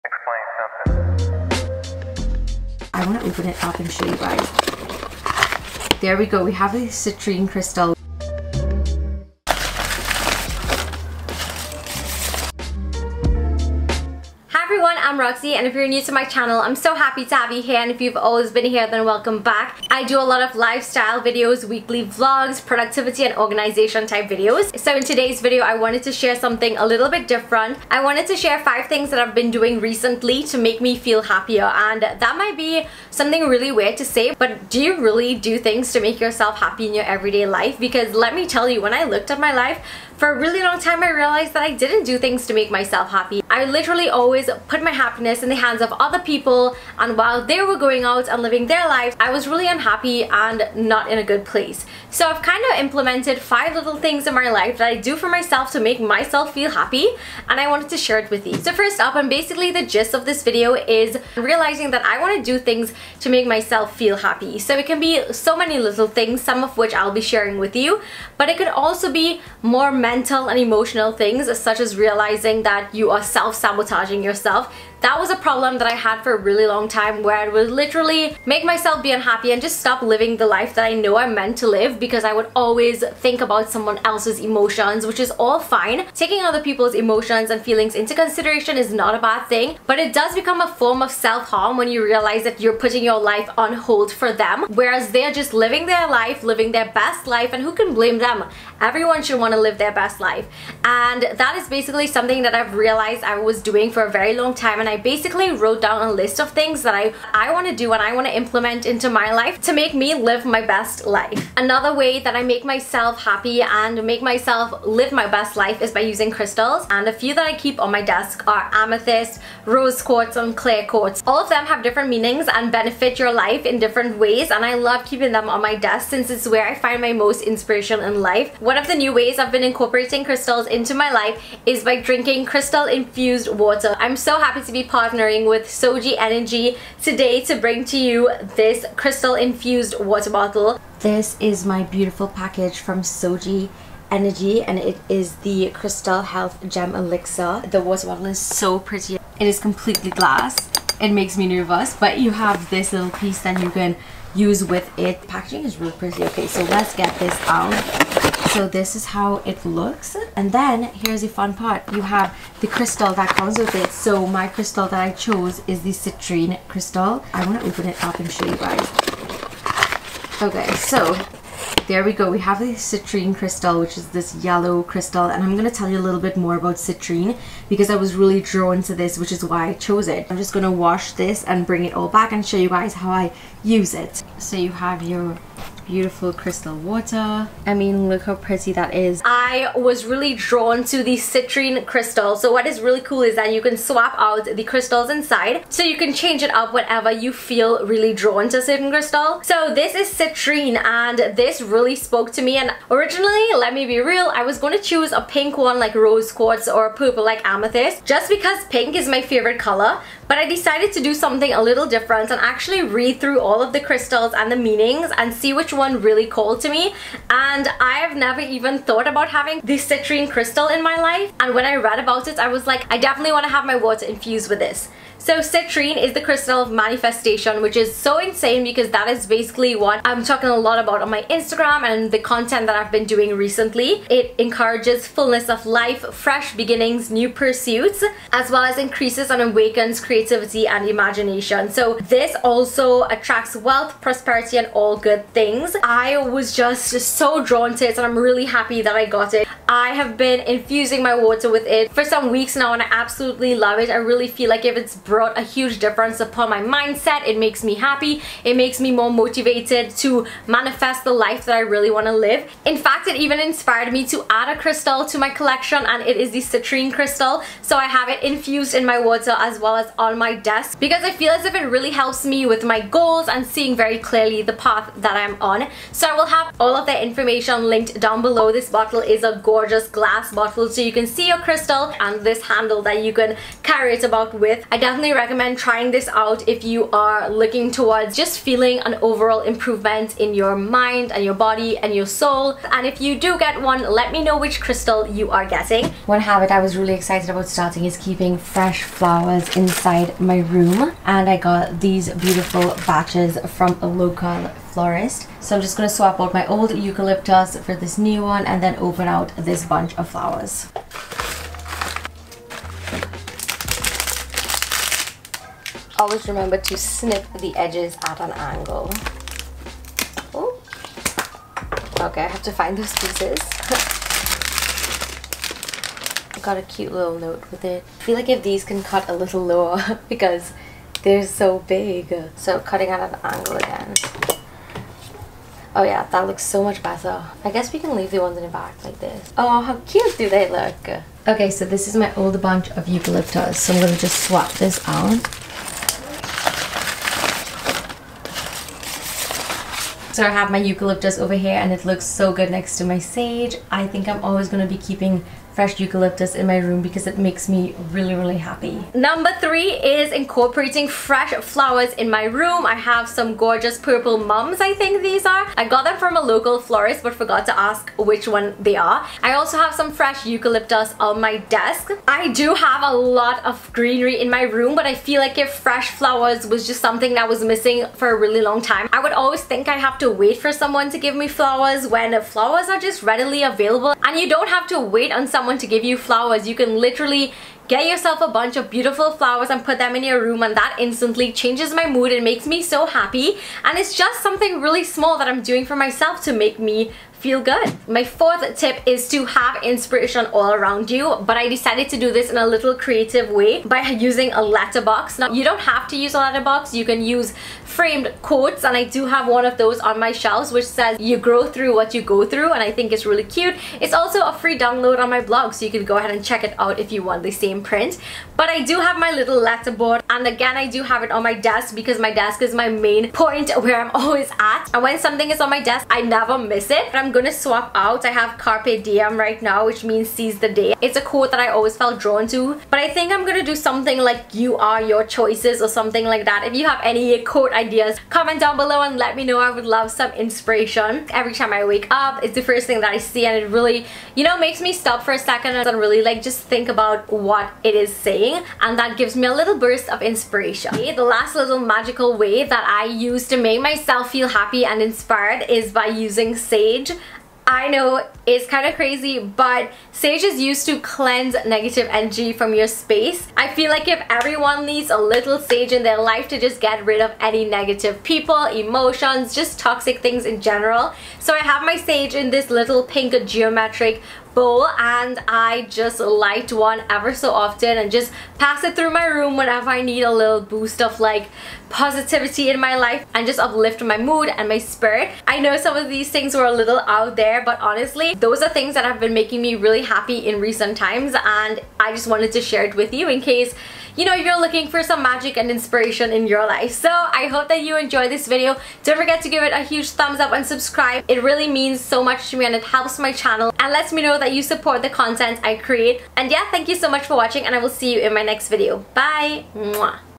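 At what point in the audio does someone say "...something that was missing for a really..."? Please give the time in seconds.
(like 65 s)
376 s.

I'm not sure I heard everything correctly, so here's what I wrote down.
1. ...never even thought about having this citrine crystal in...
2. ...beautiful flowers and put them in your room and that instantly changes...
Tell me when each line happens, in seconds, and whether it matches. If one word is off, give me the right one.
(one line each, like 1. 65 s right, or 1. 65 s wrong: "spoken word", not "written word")
1. 218 s right
2. 388 s right.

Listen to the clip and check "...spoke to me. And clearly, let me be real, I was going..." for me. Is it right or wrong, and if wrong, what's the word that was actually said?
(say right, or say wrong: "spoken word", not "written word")
wrong: "originally", not "clearly".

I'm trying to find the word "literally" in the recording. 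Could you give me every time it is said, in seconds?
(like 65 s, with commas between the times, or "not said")
43 s, 77 s, 386 s.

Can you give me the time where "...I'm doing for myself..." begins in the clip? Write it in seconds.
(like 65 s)
395 s.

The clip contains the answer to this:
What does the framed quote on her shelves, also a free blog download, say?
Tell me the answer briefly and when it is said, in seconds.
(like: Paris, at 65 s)
You grow through what you go through, at 410 s.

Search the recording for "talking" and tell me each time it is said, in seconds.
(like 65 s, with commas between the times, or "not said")
230 s.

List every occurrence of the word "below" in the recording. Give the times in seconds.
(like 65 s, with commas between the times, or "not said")
278 s, 438 s.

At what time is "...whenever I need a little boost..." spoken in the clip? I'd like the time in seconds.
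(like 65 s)
479 s.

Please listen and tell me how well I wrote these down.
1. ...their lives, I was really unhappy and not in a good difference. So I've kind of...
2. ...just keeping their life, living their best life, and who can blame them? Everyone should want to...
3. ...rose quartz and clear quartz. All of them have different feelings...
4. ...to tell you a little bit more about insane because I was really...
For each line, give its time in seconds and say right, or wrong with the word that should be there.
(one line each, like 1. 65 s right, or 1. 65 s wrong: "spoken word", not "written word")
1. 48 s wrong: "place", not "difference"
2. 95 s wrong: "living", not "keeping"
3. 119 s wrong: "meanings", not "feelings"
4. 175 s wrong: "citrine", not "insane".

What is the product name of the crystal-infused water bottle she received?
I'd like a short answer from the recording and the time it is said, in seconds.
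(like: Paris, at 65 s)
Crystal Health Gem Elixir, at 145 s.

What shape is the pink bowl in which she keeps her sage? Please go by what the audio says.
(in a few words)
geometric.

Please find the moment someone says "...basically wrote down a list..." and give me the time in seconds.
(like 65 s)
104 s.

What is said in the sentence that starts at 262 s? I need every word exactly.
In fact, it even inspired me to add a crystal to my collection and it is the citrine crystal.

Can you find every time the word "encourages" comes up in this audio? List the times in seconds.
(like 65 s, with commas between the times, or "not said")
234 s.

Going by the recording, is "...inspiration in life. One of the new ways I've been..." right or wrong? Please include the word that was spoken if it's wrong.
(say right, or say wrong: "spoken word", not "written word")
right.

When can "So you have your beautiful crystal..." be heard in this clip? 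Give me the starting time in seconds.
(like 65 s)
184 s.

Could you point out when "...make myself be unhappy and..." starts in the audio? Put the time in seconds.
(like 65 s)
78 s.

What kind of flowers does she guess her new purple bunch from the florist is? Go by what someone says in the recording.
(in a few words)
mums.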